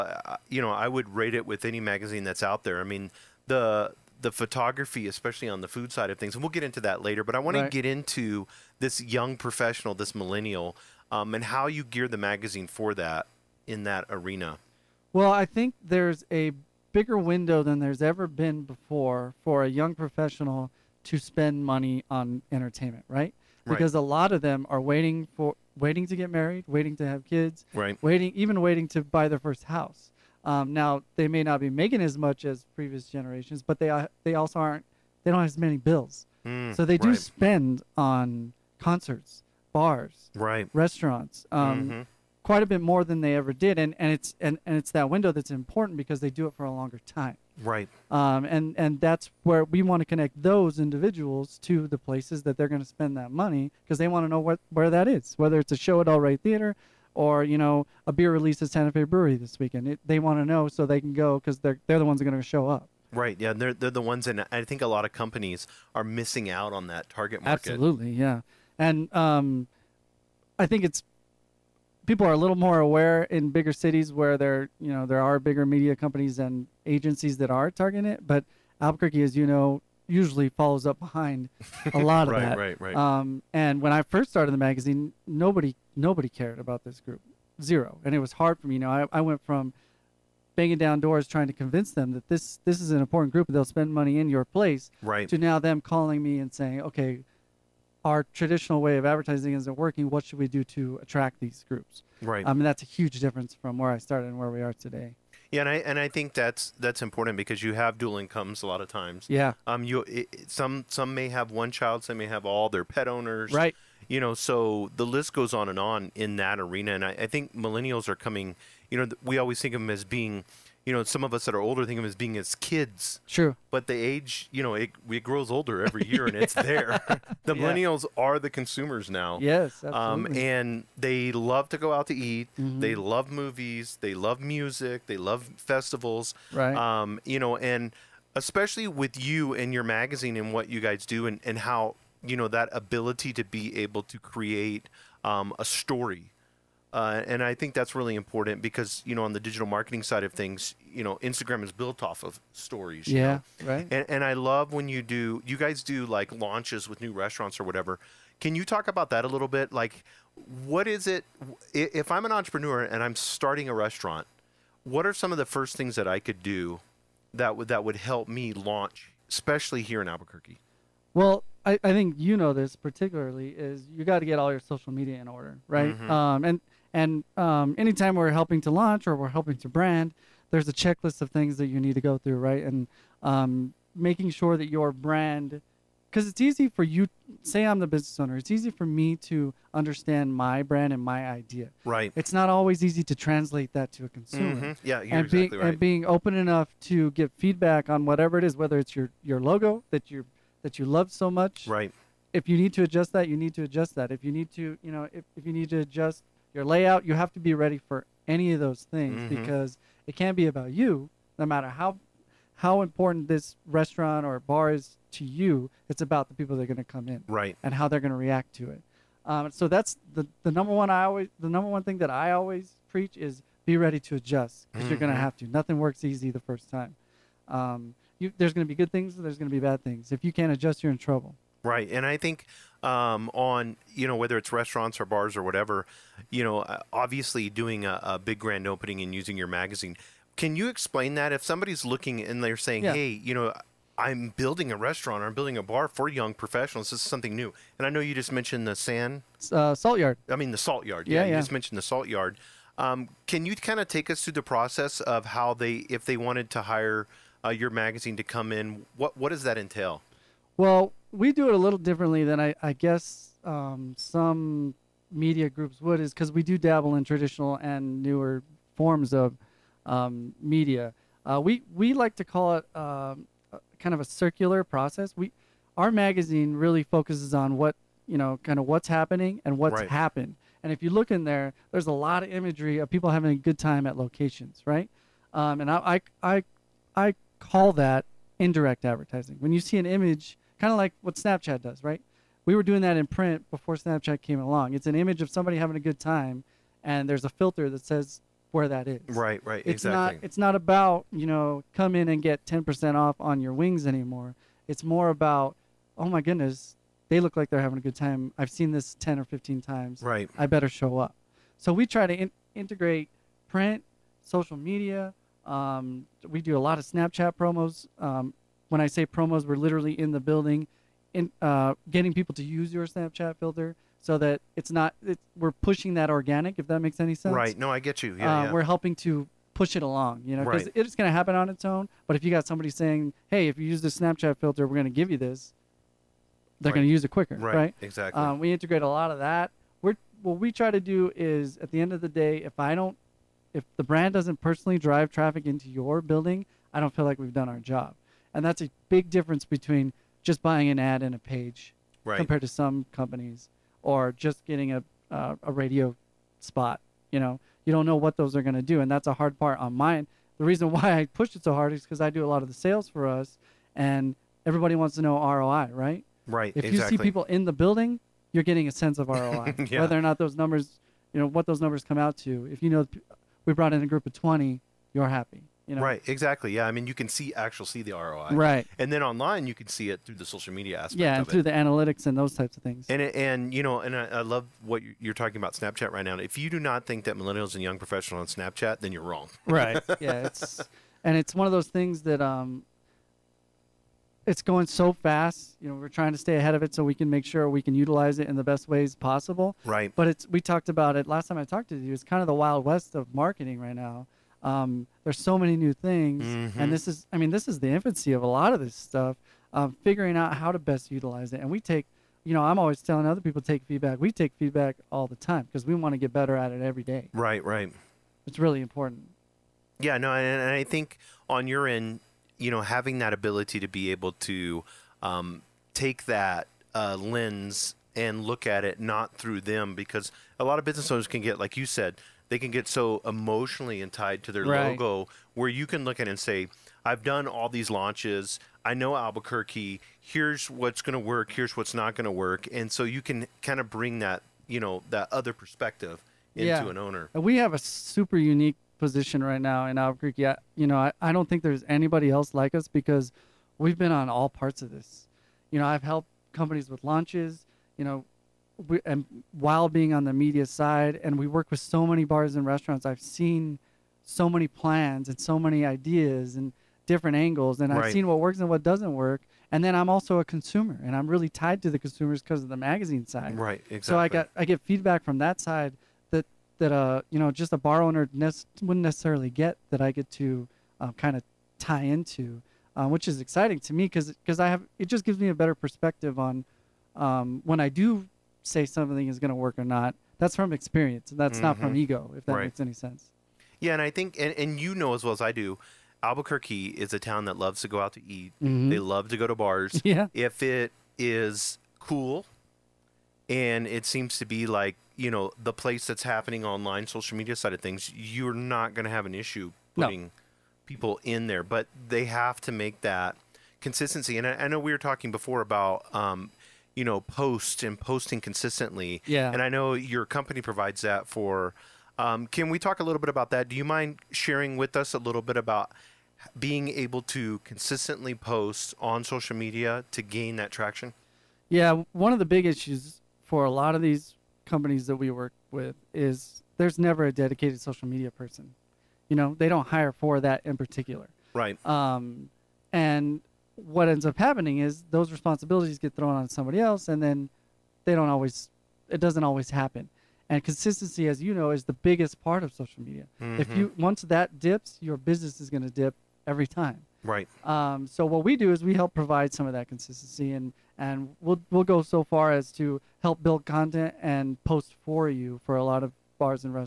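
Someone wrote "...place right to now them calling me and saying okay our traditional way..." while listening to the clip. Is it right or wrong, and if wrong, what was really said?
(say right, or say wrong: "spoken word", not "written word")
right.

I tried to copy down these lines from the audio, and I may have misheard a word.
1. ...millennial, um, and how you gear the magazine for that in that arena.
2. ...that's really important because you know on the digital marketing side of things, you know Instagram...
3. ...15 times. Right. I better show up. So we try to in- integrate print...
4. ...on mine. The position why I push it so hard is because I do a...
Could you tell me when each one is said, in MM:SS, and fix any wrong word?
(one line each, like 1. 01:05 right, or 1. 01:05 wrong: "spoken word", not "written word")
1. 00:10 right
2. 02:27 right
3. 05:09 right
4. 05:59 wrong: "reason", not "position".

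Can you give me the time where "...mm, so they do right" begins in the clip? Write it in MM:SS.
00:36.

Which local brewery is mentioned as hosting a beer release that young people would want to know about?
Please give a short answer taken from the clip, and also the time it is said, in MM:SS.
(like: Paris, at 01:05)
Santa Fe Brewery, at 00:58.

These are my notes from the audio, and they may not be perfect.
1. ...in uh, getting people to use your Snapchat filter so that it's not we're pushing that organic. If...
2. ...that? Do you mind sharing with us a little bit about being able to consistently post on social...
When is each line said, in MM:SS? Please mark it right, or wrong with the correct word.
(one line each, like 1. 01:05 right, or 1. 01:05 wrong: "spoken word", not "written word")
1. 05:21 right
2. 08:43 right.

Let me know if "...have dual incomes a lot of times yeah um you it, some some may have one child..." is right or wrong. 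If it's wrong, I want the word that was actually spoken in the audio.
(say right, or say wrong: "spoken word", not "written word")
right.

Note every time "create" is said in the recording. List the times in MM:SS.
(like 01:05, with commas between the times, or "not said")
02:24.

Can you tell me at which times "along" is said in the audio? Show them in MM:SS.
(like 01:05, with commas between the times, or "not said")
04:54, 05:29.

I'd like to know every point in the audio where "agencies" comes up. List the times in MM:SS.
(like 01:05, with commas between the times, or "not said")
01:16.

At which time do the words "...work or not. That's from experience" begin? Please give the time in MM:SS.
08:09.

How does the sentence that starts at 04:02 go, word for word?
"Hey, you know, I'm building a restaurant or I'm building a bar for young professionals.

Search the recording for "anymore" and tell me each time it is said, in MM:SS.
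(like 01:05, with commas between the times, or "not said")
05:03.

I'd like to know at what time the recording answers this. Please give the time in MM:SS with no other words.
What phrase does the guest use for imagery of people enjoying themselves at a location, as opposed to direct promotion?
04:48.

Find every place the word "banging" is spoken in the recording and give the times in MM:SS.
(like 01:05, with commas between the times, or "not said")
01:30.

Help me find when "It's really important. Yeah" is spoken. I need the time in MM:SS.
06:58.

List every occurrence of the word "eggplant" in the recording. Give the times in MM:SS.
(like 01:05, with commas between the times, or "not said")
not said.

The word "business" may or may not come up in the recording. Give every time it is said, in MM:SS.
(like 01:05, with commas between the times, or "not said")
03:07, 07:10, 09:14.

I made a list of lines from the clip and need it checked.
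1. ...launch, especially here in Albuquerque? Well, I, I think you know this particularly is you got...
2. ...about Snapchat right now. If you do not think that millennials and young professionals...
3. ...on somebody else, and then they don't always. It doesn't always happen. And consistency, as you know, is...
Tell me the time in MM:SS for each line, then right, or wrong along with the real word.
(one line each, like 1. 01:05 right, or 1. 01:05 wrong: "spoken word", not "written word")
1. 02:48 right
2. 06:25 right
3. 09:06 right.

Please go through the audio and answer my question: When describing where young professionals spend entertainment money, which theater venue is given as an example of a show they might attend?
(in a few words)
El Rey Theater.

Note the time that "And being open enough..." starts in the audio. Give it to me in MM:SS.
03:15.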